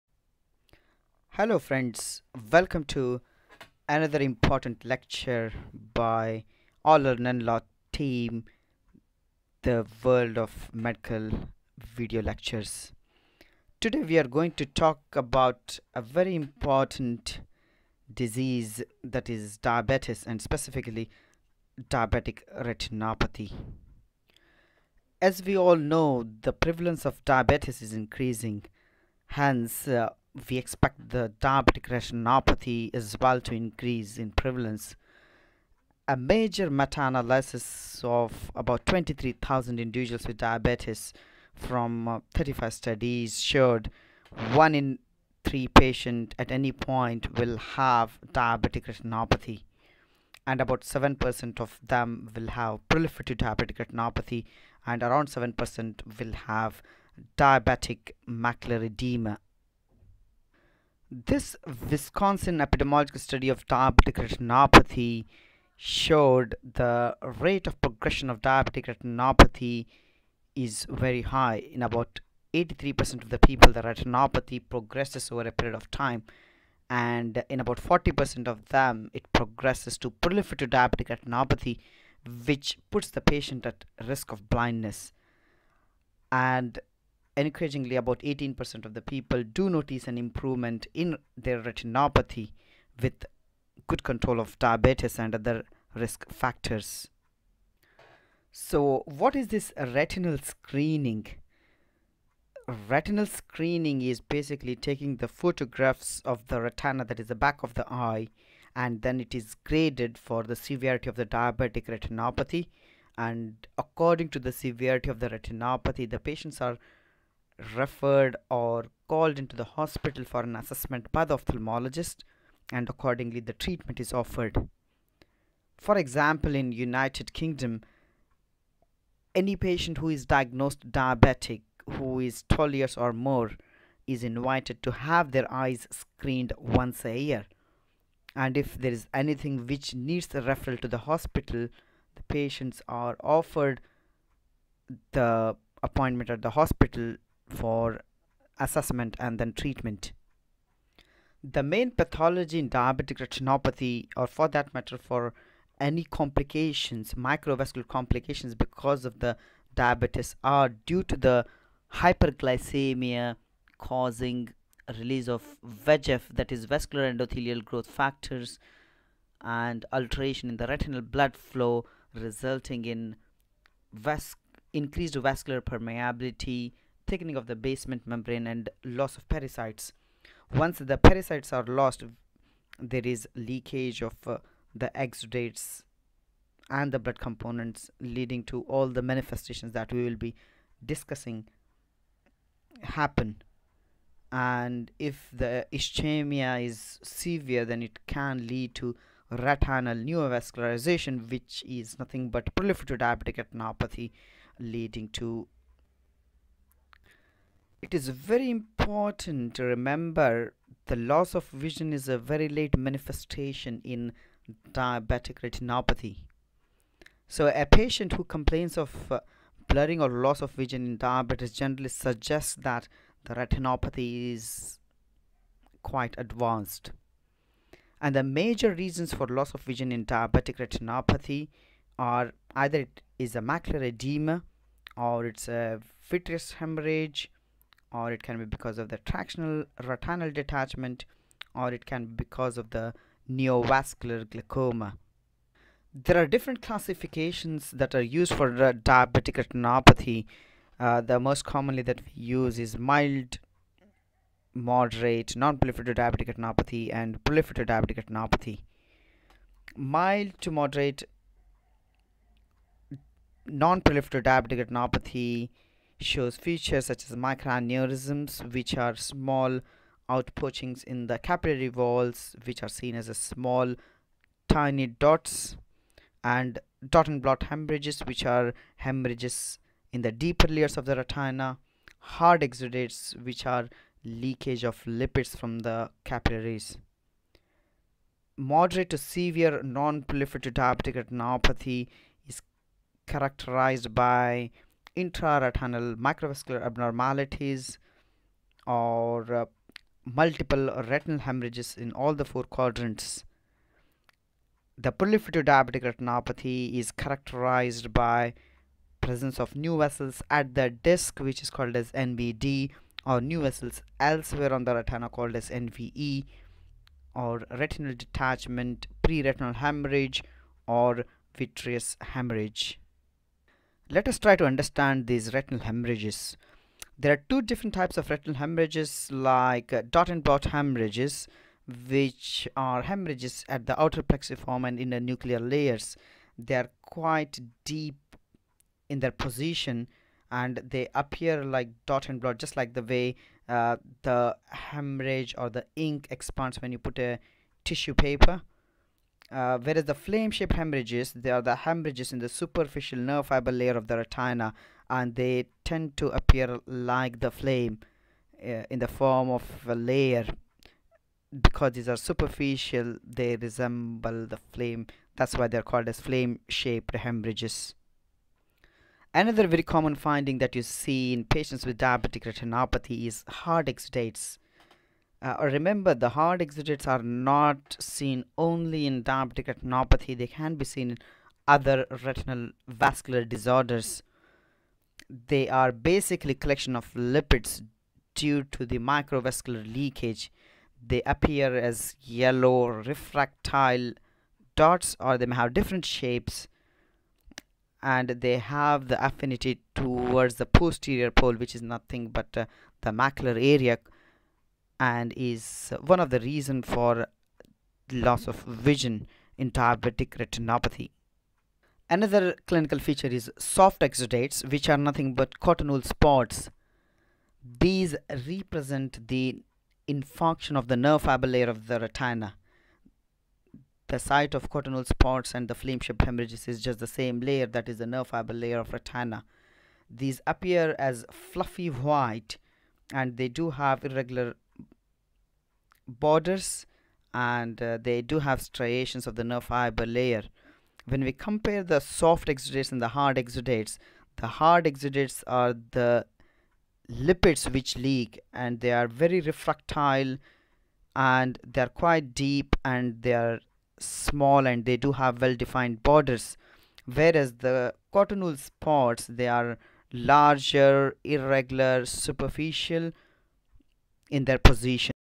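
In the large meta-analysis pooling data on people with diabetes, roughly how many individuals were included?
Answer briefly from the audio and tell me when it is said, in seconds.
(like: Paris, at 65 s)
23,000, at 38 s.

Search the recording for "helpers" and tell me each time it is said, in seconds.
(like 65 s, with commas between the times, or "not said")
not said.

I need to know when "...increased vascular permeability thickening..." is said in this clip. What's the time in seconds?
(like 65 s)
174 s.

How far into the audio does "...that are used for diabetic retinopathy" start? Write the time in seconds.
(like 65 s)
247 s.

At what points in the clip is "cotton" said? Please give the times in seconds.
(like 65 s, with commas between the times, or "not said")
415 s, 424 s, 457 s.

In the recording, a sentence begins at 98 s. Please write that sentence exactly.
So, what is this retinal screening?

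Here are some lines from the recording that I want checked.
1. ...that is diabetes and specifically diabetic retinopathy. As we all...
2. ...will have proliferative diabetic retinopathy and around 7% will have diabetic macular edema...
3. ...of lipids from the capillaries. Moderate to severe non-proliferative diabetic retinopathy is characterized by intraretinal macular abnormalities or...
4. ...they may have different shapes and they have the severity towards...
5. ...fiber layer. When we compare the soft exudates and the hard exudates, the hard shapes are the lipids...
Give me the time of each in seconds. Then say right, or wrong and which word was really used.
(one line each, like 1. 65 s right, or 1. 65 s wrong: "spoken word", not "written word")
1. 19 s right
2. 52 s right
3. 284 s wrong: "microvascular", not "macular"
4. 395 s wrong: "affinity", not "severity"
5. 439 s wrong: "exudates", not "shapes".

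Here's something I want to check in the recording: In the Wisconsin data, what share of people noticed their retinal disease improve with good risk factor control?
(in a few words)
18%.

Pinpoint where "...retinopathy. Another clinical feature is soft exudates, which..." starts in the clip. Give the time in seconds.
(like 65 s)
410 s.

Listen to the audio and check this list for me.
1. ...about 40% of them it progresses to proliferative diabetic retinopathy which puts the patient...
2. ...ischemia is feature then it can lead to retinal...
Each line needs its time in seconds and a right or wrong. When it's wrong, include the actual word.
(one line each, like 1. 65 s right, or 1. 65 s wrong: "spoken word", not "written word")
1. 77 s right
2. 195 s wrong: "severe", not "feature".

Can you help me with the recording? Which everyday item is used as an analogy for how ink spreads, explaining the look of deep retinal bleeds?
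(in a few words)
tissue paper.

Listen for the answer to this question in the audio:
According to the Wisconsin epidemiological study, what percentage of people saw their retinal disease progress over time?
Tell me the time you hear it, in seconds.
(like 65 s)
72 s.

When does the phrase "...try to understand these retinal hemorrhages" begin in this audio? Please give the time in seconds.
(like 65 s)
324 s.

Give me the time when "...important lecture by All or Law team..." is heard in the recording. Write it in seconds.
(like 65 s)
4 s.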